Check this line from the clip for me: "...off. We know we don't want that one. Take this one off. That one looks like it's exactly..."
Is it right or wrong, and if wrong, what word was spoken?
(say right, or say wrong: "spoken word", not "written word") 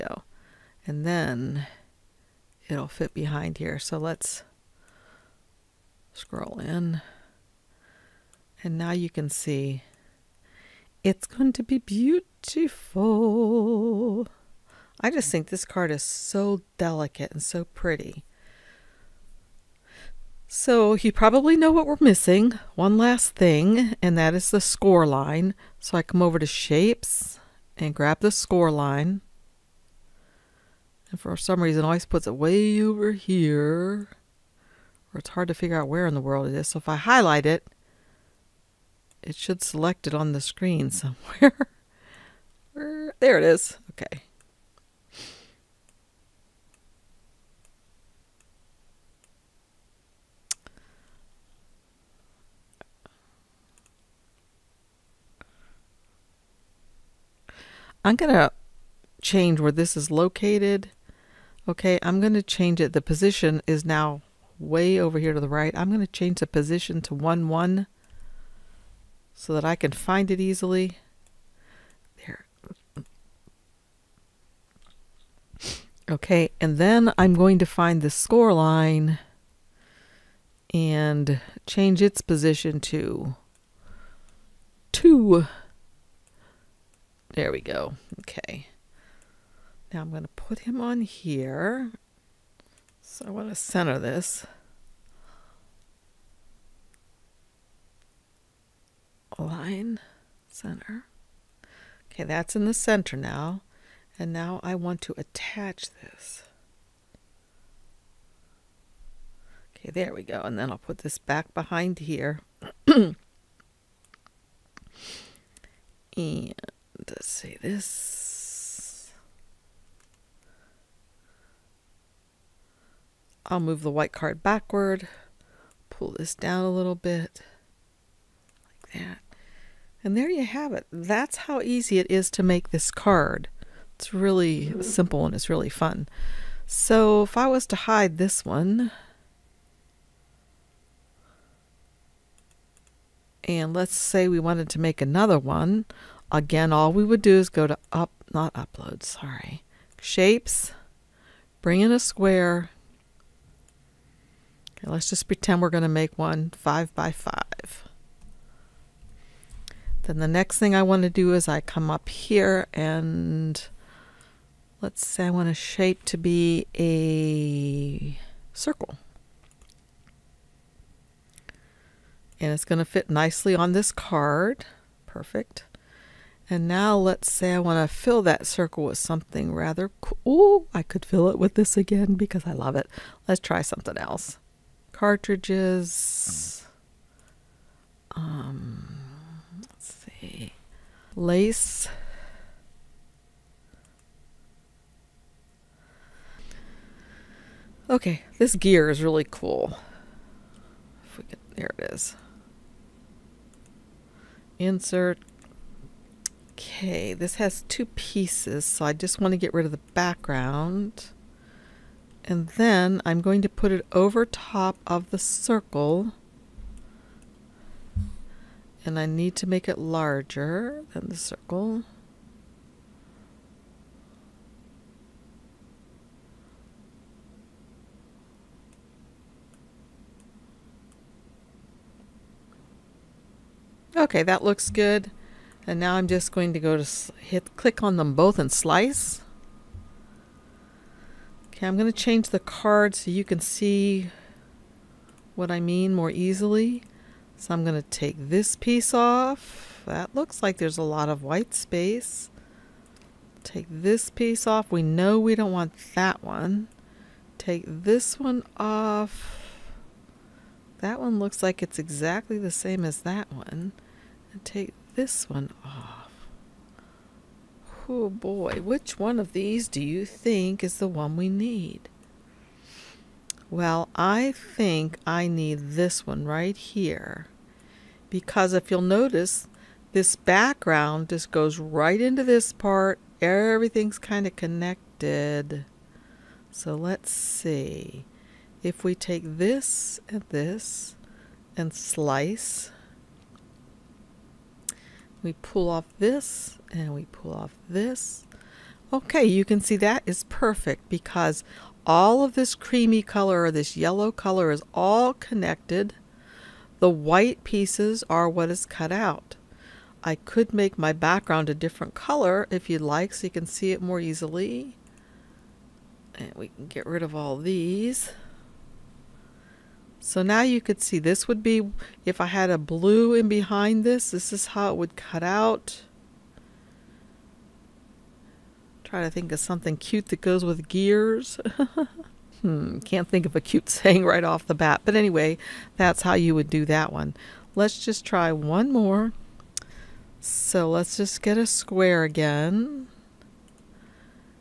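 right.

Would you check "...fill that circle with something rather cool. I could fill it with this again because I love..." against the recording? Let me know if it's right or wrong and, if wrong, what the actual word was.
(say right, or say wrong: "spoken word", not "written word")
right.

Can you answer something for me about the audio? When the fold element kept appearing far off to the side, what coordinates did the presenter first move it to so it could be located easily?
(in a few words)
1, 1.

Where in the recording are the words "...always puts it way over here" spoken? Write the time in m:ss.
0:31.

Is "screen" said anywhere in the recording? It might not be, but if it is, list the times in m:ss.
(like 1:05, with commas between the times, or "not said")
0:40.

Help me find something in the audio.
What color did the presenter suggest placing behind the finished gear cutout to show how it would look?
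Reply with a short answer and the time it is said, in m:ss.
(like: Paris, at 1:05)
blue, at 5:22.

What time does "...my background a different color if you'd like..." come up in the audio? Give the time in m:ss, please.
5:10.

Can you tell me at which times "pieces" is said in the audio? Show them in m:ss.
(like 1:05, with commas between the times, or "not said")
3:27, 4:08, 4:14, 5:07.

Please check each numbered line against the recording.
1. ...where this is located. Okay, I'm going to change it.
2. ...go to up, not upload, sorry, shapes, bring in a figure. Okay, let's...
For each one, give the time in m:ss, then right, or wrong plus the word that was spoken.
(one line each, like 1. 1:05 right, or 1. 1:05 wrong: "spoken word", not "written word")
1. 0:59 right
2. 2:27 wrong: "square", not "figure".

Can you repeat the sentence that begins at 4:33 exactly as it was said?
Well, I think I need this one right here.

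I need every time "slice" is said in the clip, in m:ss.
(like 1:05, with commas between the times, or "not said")
3:58, 4:51.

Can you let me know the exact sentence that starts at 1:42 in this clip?
Okay, that's in the center now.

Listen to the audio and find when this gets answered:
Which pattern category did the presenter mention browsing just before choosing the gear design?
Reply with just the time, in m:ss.
3:11.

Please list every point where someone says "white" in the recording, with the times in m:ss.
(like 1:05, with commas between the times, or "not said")
2:03, 4:11, 5:06.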